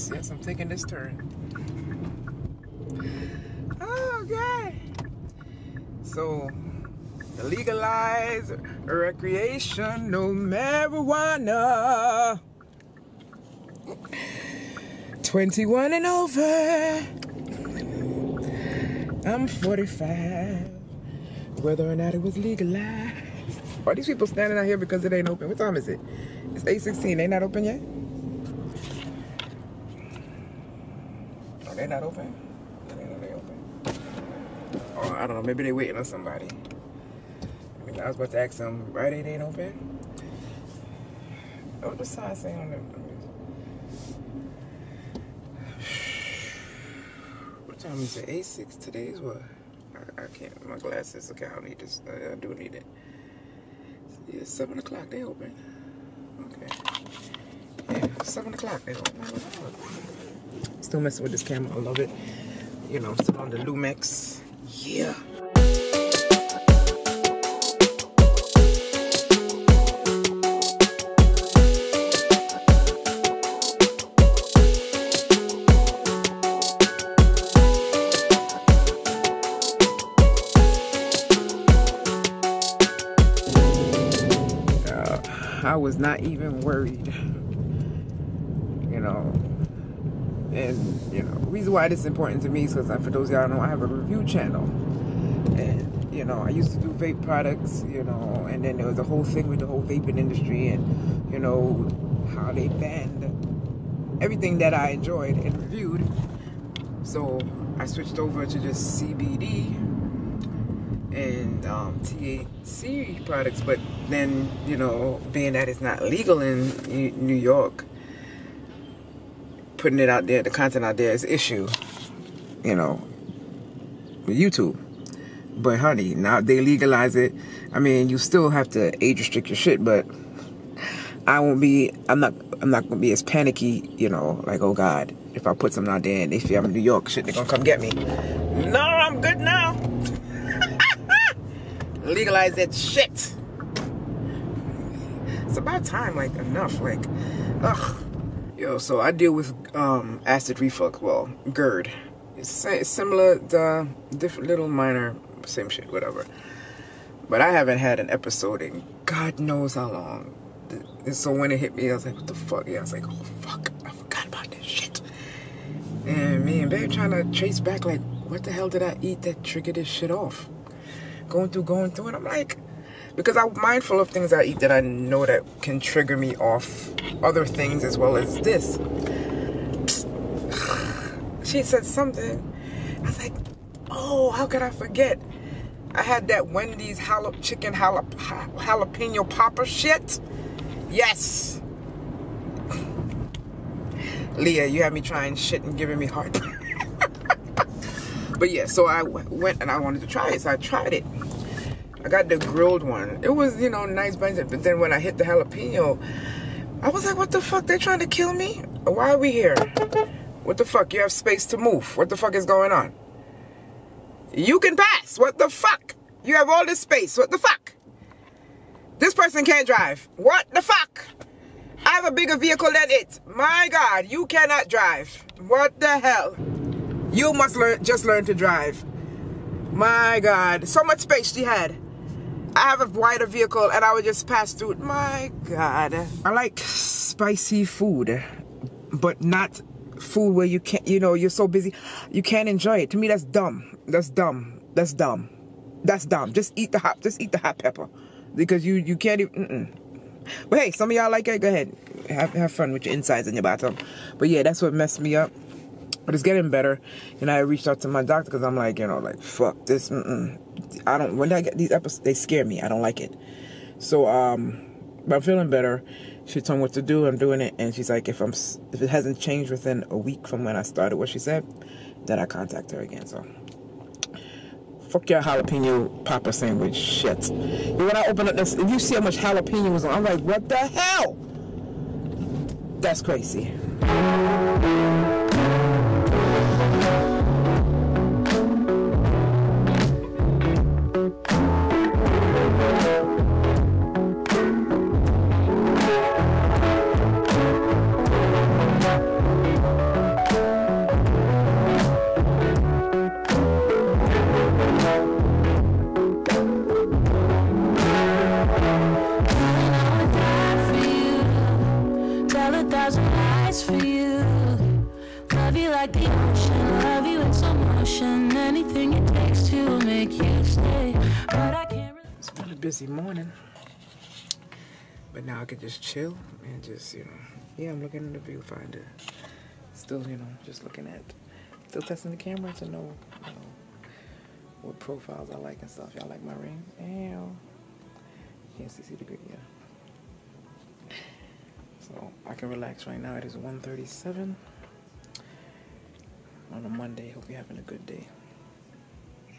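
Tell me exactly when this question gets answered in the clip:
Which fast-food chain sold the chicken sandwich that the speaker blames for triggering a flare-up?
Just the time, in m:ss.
3:06.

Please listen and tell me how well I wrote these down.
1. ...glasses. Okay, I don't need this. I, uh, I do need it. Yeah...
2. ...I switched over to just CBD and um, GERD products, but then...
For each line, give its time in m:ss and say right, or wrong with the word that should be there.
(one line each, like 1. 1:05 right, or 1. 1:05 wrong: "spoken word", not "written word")
1. 0:50 right
2. 1:47 wrong: "THC", not "GERD".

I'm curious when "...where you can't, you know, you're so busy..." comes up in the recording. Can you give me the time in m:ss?
4:00.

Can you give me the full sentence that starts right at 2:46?
And me and babe trying to trace back, like, what the hell did I eat that triggered this shit off?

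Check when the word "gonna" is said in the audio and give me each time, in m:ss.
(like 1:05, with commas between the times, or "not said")
2:12, 2:17.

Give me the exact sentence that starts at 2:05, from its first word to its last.
But honey, now they legalize it.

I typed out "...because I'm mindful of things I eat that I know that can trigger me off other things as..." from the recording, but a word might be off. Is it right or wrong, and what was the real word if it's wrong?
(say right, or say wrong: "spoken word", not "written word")
right.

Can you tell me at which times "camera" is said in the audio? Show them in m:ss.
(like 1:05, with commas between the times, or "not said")
1:01, 5:32.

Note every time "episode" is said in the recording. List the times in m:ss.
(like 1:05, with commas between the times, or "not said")
2:38, 4:21.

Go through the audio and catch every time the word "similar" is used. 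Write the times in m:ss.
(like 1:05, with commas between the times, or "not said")
2:32.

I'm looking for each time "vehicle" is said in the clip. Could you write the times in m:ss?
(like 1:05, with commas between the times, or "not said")
3:42, 3:53.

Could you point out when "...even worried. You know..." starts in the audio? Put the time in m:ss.
1:26.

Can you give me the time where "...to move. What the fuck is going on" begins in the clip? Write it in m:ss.
3:31.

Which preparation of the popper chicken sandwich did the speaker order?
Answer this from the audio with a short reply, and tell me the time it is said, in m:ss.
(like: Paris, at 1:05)
grilled, at 3:22.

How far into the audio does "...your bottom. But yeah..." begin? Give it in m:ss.
4:13.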